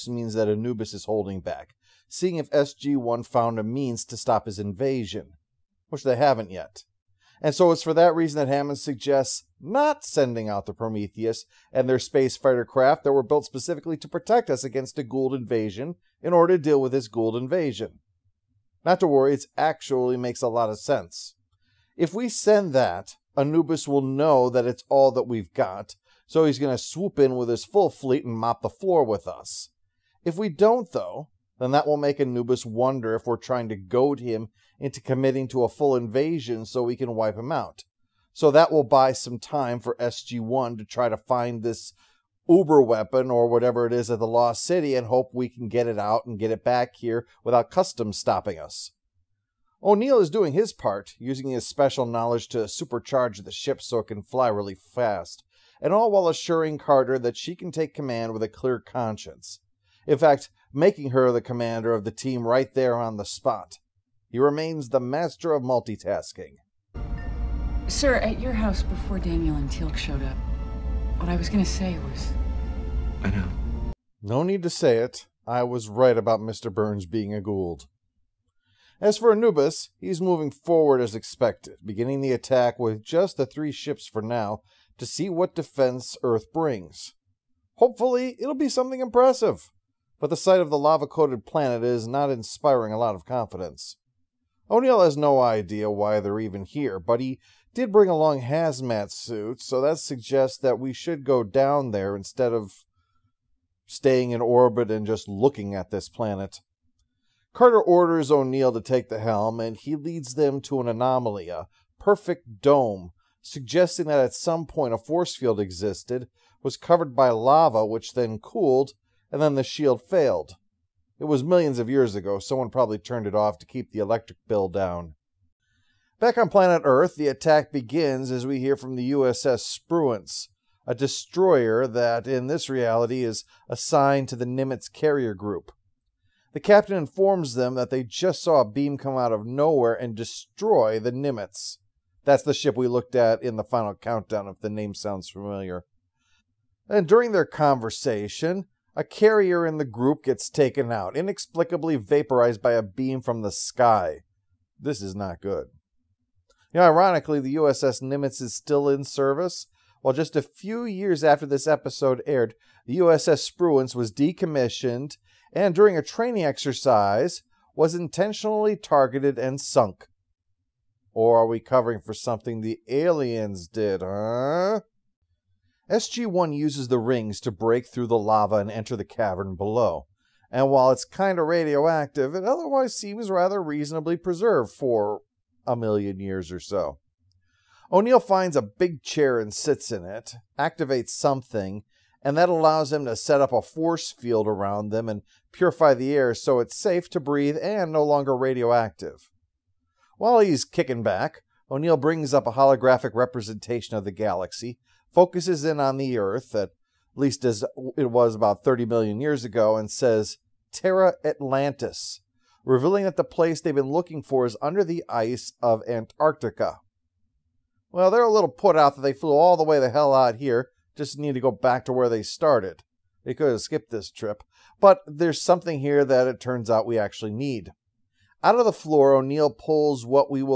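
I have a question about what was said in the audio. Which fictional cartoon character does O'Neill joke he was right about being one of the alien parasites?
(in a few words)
Mr. Burns.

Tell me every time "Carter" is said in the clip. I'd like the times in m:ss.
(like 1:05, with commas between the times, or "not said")
0:56, 1:47.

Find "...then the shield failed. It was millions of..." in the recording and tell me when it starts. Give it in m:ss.
1:59.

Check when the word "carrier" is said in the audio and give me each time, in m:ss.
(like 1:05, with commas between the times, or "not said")
2:14, 2:29.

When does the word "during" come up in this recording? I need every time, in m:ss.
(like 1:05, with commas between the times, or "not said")
2:27, 2:45.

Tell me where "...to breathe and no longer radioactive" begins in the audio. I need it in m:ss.
3:17.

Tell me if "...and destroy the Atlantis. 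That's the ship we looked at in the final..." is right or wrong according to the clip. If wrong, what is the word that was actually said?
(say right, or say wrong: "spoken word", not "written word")
wrong: "Nimitz", not "Atlantis".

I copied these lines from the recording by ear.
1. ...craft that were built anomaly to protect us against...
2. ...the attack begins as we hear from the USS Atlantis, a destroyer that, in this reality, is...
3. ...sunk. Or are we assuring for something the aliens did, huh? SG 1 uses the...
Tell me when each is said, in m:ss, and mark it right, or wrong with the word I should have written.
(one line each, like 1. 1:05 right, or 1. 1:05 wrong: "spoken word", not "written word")
1. 0:12 wrong: "specifically", not "anomaly"
2. 2:07 wrong: "Spruance", not "Atlantis"
3. 2:49 wrong: "covering", not "assuring".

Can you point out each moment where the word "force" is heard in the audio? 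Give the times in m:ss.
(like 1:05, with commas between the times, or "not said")
1:54, 3:13.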